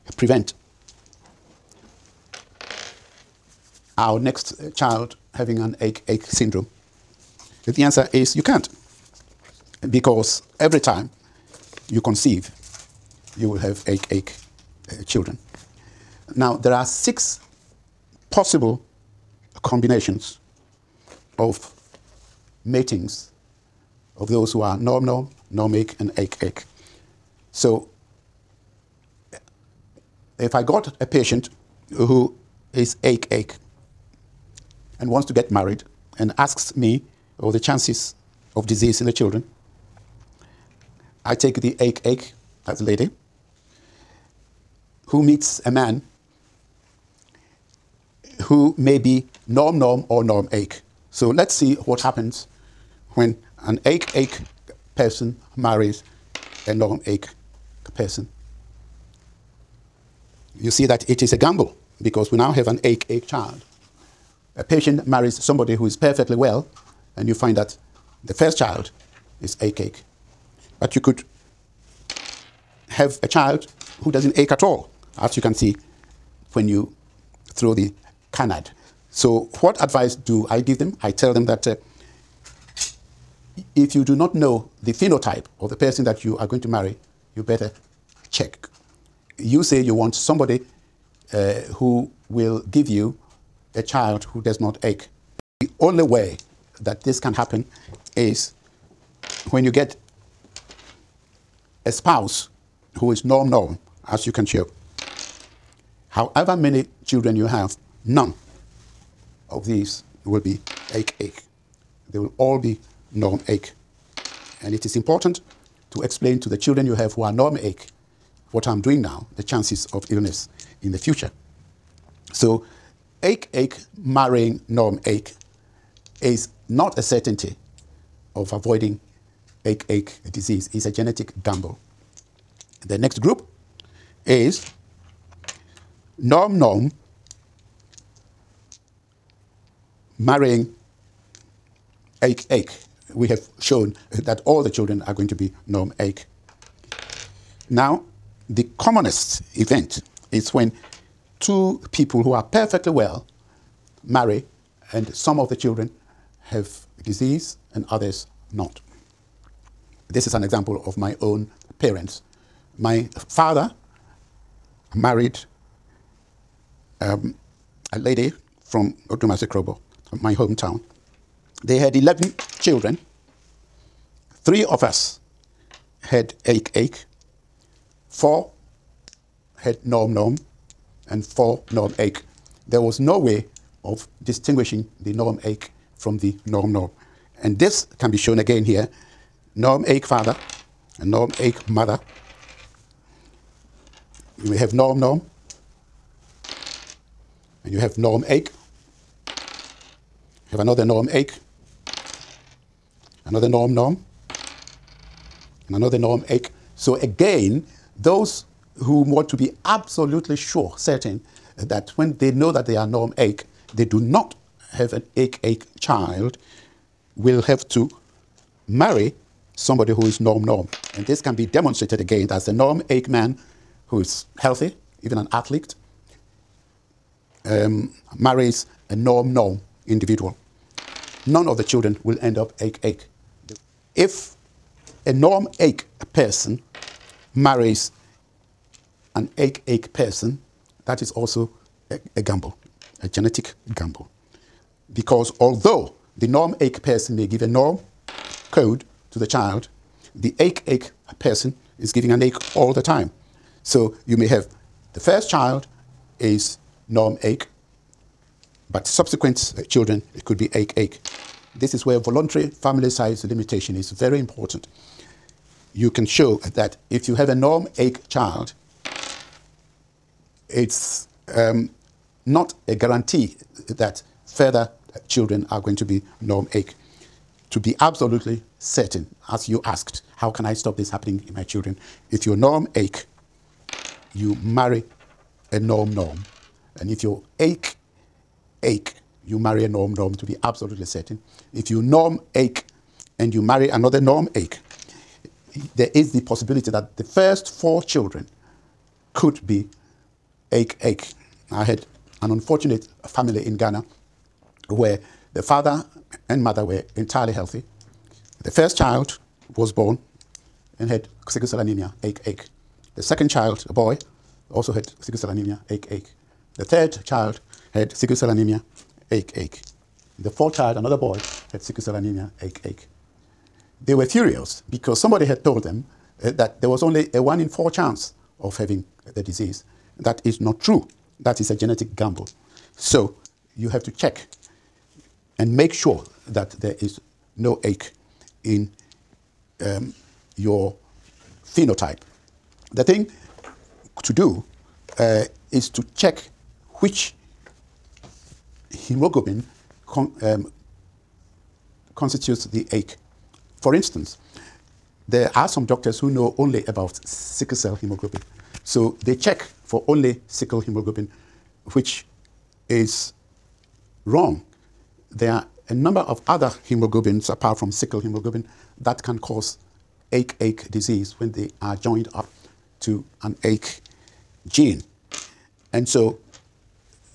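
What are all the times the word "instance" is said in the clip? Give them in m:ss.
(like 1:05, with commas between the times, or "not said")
5:53.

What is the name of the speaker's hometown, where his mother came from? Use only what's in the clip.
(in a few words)
Odumase Krobo.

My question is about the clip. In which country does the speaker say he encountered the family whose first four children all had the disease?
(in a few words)
Ghana.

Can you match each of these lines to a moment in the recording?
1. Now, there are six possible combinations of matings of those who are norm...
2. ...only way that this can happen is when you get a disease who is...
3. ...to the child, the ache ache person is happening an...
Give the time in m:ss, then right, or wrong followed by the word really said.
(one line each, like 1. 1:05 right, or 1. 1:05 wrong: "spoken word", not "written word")
1. 0:16 right
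2. 1:35 wrong: "spouse", not "disease"
3. 4:09 wrong: "giving", not "happening".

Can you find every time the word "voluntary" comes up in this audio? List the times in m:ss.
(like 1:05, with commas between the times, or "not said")
4:21.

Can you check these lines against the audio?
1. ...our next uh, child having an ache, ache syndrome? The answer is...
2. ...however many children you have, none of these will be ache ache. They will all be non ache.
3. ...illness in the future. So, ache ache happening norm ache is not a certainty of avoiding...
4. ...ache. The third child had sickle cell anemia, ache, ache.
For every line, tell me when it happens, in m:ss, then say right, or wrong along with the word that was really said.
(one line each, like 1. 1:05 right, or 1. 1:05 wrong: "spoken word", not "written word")
1. 0:04 right
2. 1:46 right
3. 2:00 wrong: "marrying", not "happening"
4. 5:15 right.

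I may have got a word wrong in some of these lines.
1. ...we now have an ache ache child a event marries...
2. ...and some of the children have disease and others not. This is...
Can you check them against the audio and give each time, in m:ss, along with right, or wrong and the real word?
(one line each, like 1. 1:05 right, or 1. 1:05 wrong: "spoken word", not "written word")
1. 1:02 wrong: "patient", not "event"
2. 2:34 right.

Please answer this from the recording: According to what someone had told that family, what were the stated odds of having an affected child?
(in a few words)
one in four.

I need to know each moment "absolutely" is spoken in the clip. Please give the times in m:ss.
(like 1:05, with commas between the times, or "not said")
3:29, 4:37, 4:50.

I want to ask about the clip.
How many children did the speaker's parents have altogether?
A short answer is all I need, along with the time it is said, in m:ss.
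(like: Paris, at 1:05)
11, at 2:51.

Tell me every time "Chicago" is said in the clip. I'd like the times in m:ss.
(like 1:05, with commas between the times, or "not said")
not said.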